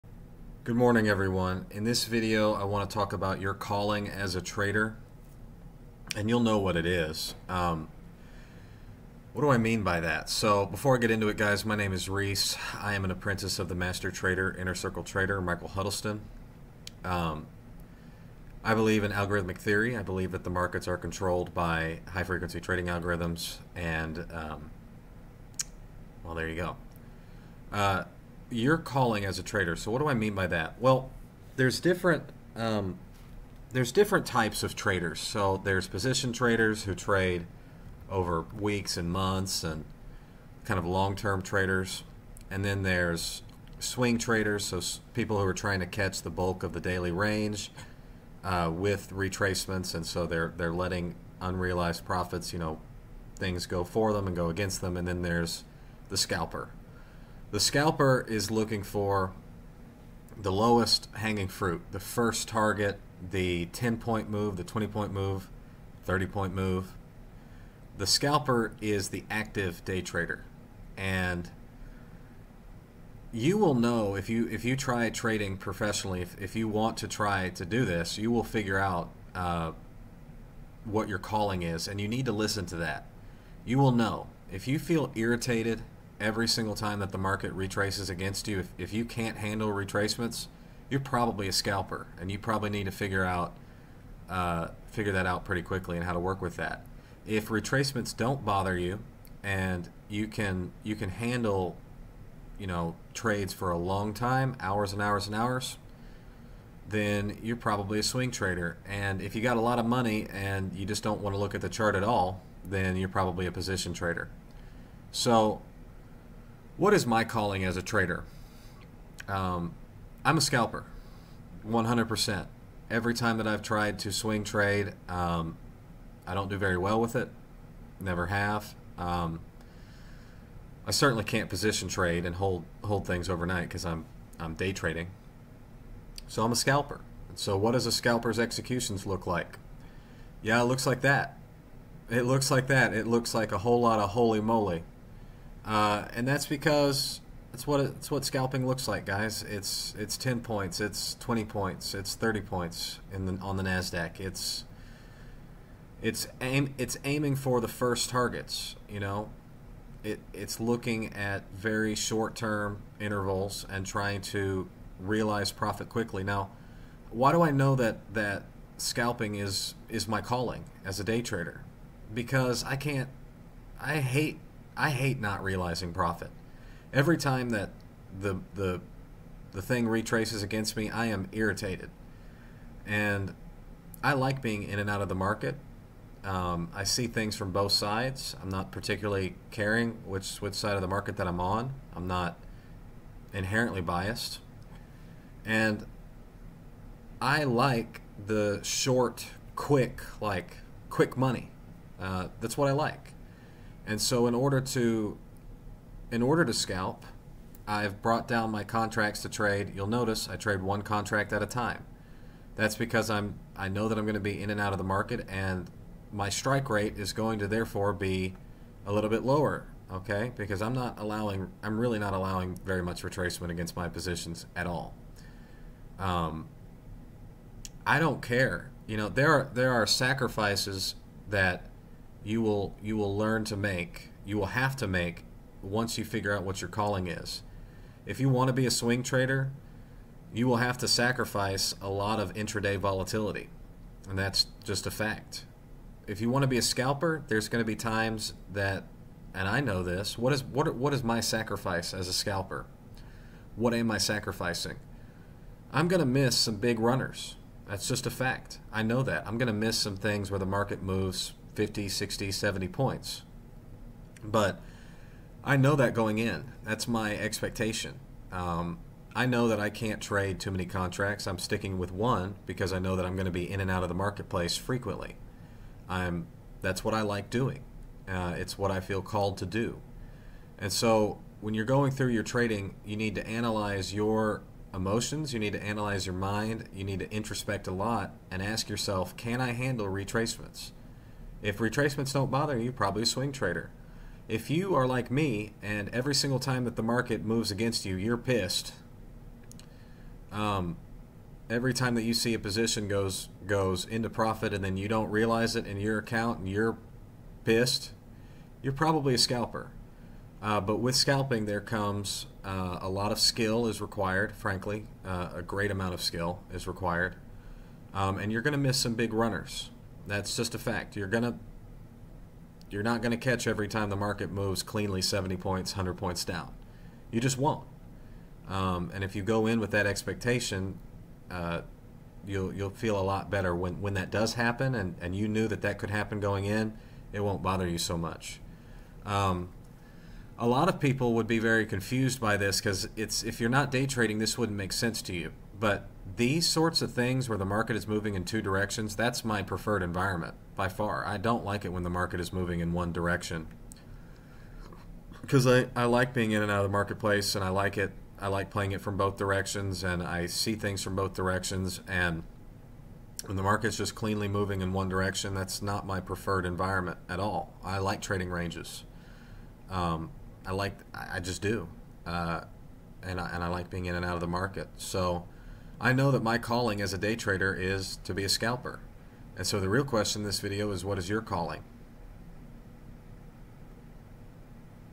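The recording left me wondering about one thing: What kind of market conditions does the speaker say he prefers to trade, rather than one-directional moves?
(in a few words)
ranges.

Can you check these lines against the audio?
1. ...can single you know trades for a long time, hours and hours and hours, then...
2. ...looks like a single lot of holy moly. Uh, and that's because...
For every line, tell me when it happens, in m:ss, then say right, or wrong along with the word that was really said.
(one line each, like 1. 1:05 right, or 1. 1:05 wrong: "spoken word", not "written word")
1. 1:40 wrong: "handle", not "single"
2. 2:23 wrong: "whole", not "single".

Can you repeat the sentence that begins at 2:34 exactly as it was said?
It's it's aim it's aiming for the first targets, you know.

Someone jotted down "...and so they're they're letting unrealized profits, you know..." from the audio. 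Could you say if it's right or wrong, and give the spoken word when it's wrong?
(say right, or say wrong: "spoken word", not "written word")
right.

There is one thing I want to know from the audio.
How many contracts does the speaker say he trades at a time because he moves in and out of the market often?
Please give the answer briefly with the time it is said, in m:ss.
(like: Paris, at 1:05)
1, at 3:30.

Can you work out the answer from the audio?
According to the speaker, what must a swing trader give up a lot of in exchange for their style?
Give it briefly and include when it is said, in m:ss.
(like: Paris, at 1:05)
intraday volatility, at 4:02.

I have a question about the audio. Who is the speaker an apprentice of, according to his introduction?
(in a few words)
Michael Huddleston.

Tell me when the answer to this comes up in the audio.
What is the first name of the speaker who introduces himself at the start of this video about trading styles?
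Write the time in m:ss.
0:12.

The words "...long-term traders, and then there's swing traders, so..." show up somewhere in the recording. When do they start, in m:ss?
0:40.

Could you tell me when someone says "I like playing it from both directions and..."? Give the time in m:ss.
5:58.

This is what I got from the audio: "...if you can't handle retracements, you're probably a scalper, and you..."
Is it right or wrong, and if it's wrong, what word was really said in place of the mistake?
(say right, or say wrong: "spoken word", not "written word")
right.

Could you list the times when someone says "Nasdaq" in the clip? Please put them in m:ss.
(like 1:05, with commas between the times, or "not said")
2:33.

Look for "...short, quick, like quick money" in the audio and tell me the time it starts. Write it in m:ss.
3:18.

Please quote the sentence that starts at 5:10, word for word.
Uh, but with scalping, there comes uh, a lot of skill is required.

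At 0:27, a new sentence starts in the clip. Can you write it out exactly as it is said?
Uh, your calling as a trader.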